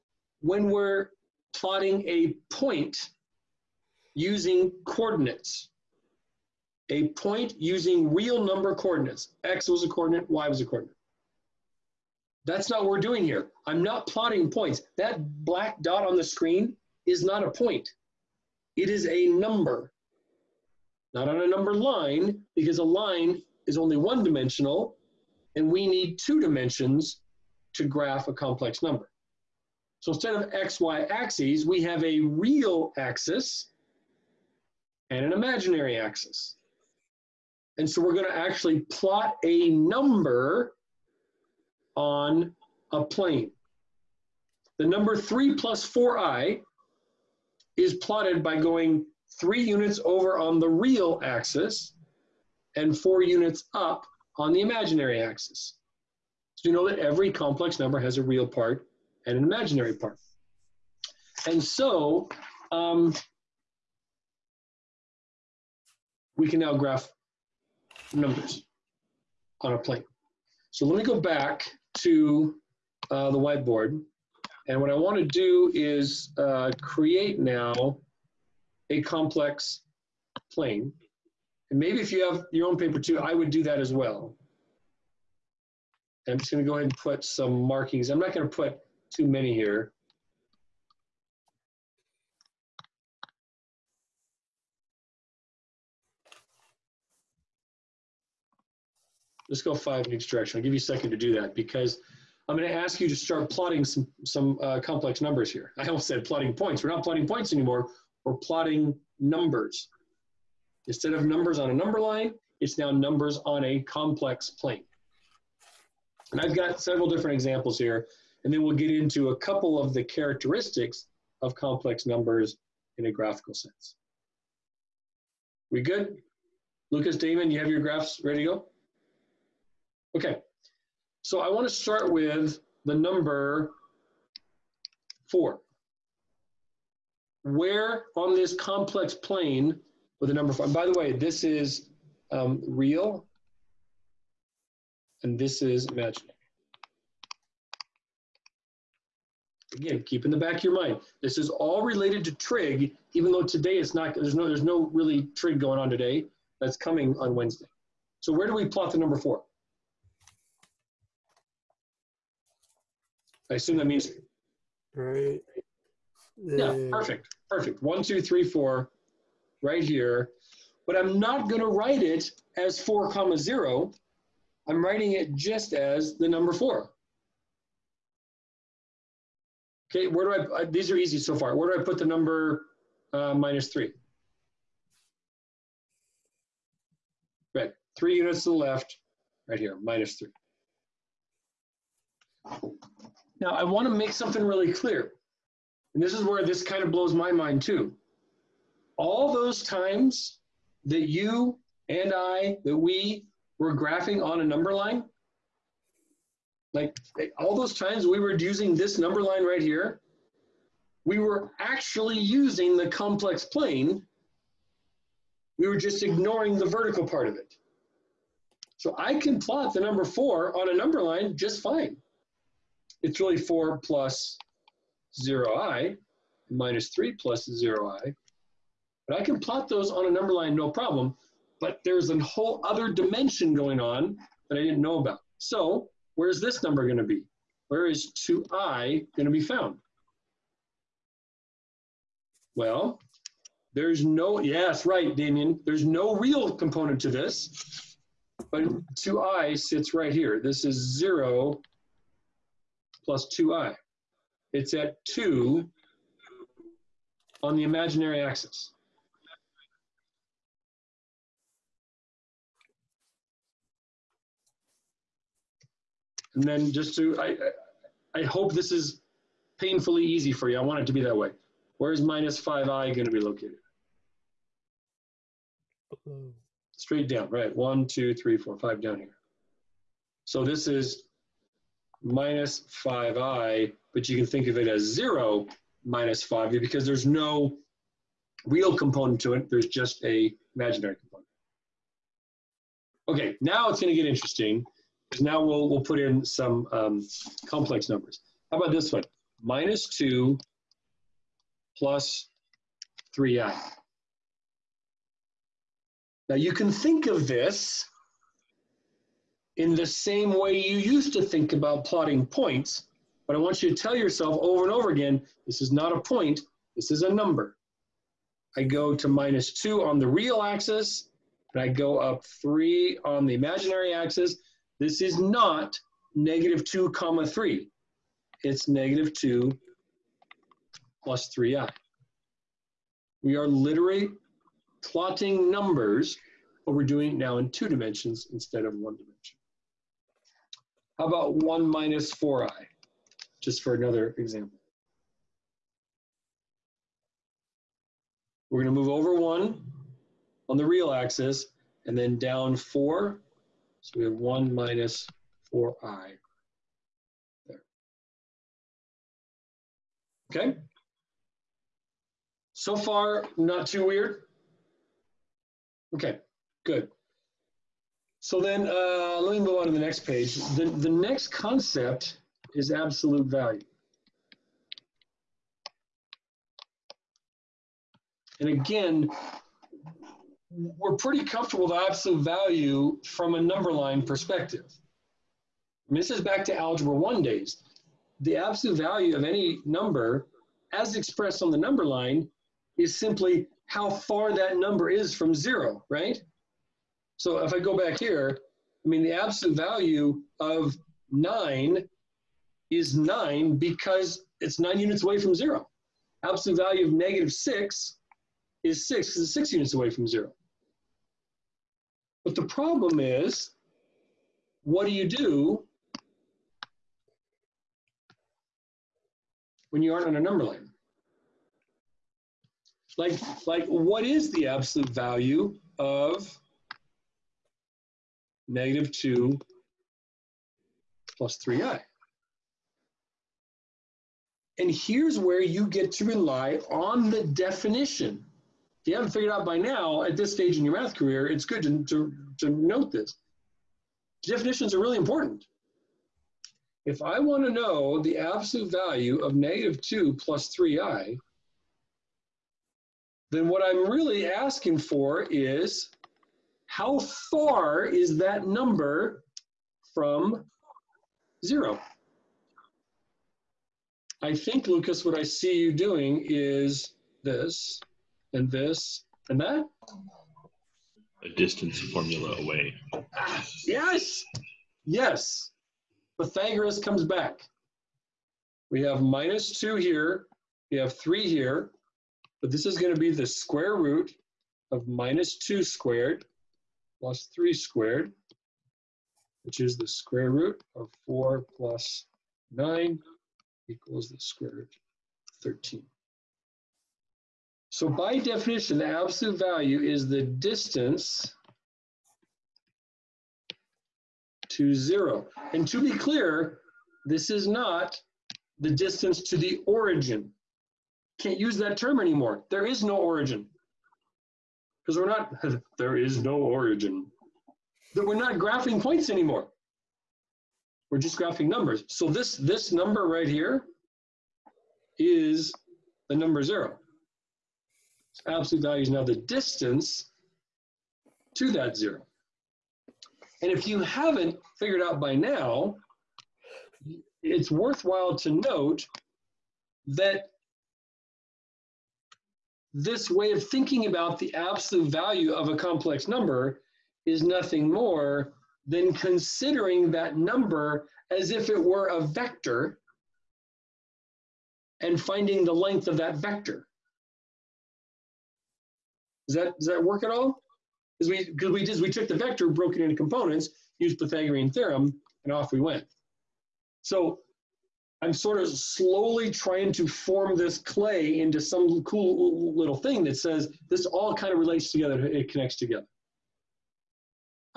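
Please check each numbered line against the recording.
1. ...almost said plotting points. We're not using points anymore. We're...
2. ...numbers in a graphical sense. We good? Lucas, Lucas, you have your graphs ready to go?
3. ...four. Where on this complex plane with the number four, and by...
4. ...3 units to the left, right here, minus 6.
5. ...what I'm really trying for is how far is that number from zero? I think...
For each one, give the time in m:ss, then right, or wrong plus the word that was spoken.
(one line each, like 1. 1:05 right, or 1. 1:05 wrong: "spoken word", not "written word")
1. 1:45 wrong: "plotting", not "using"
2. 2:02 wrong: "Damon", not "Lucas"
3. 2:15 right
4. 3:07 wrong: "3", not "6"
5. 7:33 wrong: "asking", not "trying".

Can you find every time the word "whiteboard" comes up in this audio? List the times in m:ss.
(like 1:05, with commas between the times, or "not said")
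1:13.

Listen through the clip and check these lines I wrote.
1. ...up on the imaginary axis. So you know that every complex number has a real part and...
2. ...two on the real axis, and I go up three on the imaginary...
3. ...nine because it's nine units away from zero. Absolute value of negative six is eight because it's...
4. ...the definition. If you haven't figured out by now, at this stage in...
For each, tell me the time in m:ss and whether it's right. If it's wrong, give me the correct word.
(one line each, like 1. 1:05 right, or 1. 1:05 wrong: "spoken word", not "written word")
1. 0:53 right
2. 5:19 right
3. 6:42 wrong: "six", not "eight"
4. 7:17 right.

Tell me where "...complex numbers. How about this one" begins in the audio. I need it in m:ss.
4:57.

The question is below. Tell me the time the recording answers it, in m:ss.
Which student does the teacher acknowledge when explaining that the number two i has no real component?
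4:05.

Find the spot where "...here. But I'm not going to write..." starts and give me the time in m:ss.
2:49.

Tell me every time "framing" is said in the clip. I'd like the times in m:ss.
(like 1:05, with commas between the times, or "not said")
not said.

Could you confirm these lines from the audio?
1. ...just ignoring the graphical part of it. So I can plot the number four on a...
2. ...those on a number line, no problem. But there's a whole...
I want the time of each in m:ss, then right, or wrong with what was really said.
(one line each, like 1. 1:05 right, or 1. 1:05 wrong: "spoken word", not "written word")
1. 3:35 wrong: "vertical", not "graphical"
2. 3:49 right.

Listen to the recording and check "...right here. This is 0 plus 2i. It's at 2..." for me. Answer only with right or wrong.
right.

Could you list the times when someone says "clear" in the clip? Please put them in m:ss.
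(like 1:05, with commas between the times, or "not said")
3:14, 8:25.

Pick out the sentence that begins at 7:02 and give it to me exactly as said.
Like, like what is the absolute value of negative 2 plus 3i.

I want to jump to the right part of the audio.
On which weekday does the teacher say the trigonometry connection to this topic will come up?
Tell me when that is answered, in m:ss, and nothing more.
2:37.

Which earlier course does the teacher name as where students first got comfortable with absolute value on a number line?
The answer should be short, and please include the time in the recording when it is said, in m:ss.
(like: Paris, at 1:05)
Algebra one, at 6:26.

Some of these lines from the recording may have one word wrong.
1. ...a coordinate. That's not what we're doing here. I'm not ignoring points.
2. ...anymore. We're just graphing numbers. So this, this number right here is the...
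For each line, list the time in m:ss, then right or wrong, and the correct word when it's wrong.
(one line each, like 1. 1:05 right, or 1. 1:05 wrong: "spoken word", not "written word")
1. 0:10 wrong: "plotting", not "ignoring"
2. 8:39 right.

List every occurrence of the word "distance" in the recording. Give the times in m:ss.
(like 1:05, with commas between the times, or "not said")
7:51, 8:20, 8:28, 8:49.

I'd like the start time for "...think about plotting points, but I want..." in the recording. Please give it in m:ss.
5:11.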